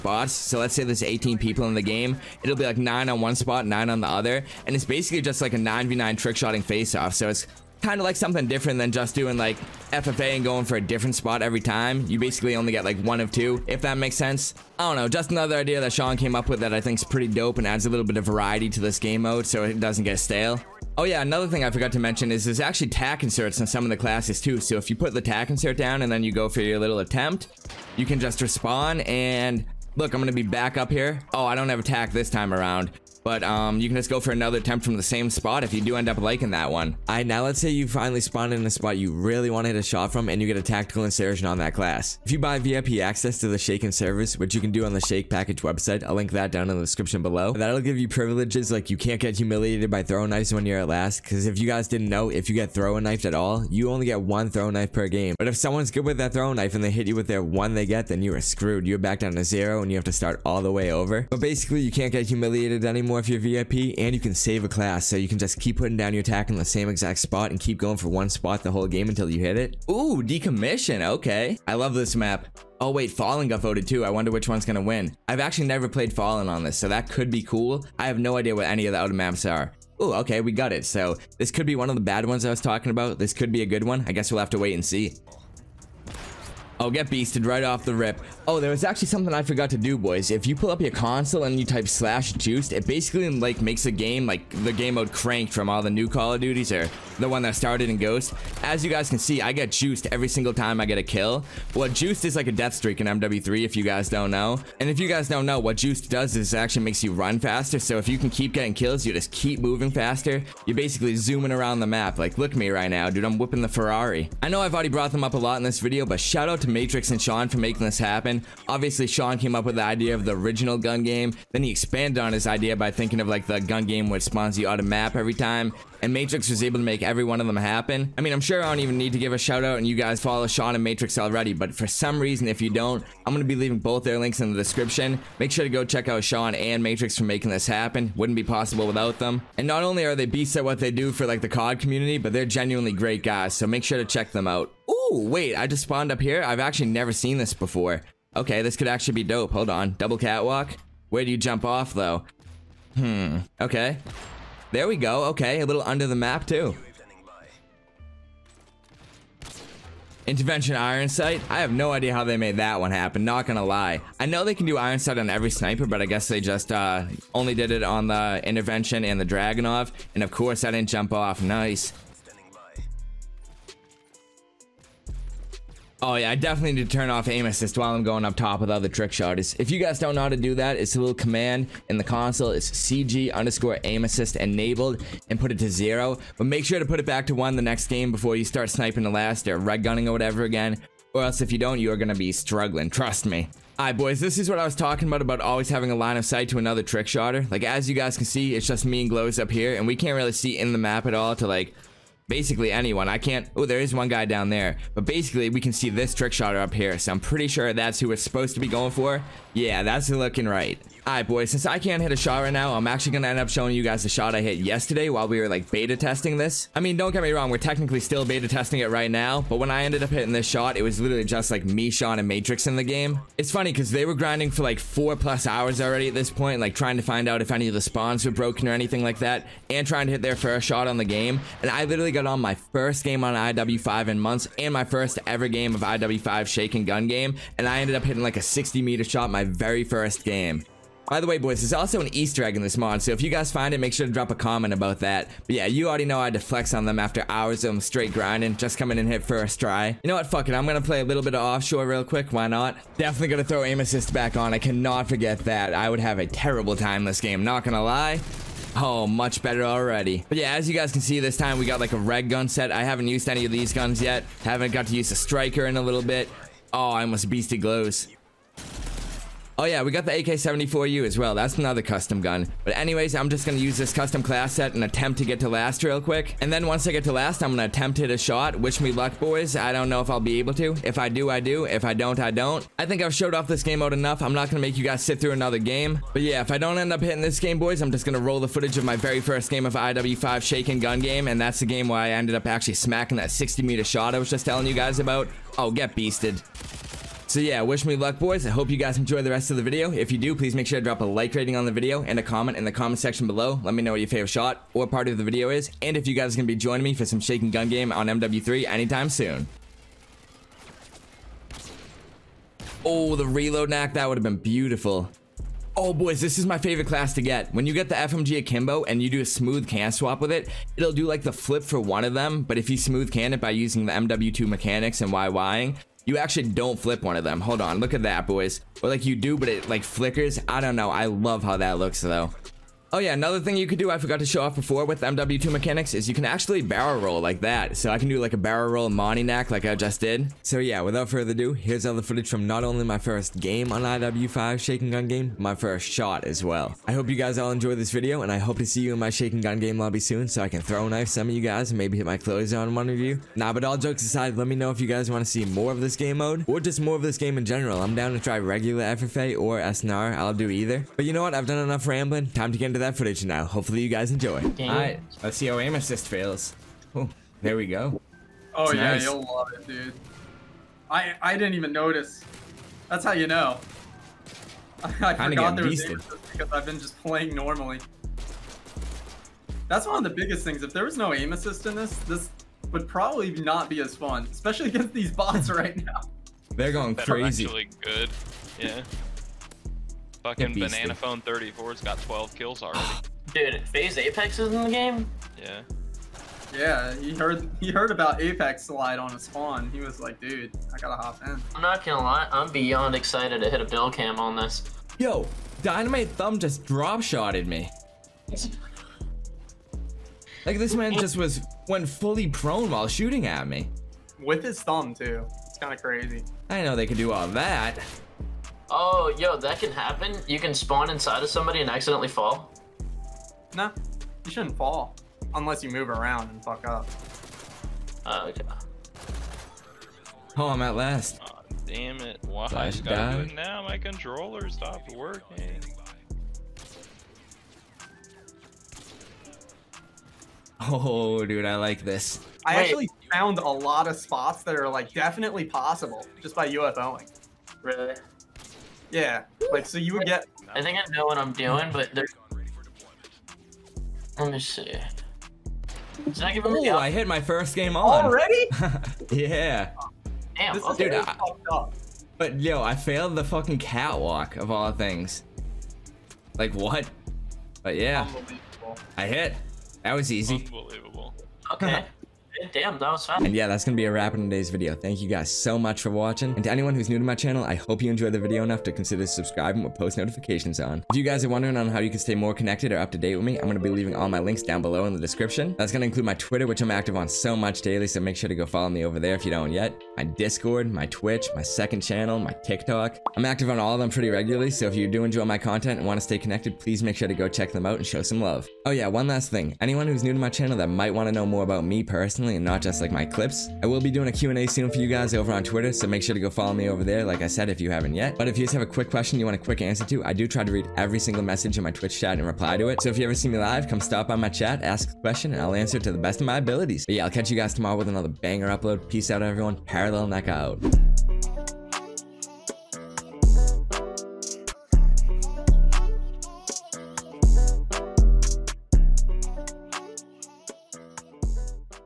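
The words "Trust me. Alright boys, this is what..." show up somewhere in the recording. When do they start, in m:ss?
3:12.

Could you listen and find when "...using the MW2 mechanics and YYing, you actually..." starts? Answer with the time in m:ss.
5:23.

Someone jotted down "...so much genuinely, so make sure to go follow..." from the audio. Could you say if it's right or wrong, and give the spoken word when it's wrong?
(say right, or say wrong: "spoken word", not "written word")
wrong: "daily", not "genuinely".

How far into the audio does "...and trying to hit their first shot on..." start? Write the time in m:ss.
3:49.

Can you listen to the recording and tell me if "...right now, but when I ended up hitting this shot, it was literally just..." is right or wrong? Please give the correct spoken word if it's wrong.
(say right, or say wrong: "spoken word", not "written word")
right.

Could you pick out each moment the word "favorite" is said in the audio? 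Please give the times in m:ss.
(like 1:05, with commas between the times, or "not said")
5:04, 5:16.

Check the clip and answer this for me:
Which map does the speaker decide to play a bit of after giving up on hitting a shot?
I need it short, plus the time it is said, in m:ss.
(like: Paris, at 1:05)
Offshore, at 4:11.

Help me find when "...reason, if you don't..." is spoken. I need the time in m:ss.
2:12.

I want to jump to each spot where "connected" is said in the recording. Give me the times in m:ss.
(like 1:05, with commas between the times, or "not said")
8:02, 8:16.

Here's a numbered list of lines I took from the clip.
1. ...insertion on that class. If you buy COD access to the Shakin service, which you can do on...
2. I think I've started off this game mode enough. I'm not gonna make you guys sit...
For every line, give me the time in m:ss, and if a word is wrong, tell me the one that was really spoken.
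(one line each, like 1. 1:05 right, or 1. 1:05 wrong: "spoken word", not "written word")
1. 0:41 wrong: "VIP", not "COD"
2. 4:42 wrong: "showed", not "started".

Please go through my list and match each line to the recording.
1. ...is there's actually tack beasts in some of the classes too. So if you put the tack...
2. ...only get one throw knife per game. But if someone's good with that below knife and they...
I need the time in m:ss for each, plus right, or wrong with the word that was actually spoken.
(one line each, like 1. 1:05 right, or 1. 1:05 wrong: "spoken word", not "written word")
1. 0:22 wrong: "inserts", not "beasts"
2. 0:53 wrong: "throw", not "below".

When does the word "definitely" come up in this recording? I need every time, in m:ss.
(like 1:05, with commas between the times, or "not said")
2:56, 4:12, 7:24.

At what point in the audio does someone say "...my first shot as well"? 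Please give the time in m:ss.
5:45.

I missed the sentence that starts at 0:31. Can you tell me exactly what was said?
Oh, I don't have attack this time around.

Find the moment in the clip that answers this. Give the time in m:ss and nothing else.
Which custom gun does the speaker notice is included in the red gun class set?
4:30.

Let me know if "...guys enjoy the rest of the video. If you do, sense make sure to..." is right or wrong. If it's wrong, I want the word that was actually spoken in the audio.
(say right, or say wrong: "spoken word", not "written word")
wrong: "please", not "sense".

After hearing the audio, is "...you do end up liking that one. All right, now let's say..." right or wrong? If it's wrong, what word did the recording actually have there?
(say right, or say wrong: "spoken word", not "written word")
right.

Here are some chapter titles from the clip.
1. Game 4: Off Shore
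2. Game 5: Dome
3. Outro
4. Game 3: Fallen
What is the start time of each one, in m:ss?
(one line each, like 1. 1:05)
1. 4:09
2. 6:04
3. 7:52
4. 1:09.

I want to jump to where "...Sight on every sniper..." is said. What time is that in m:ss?
2:44.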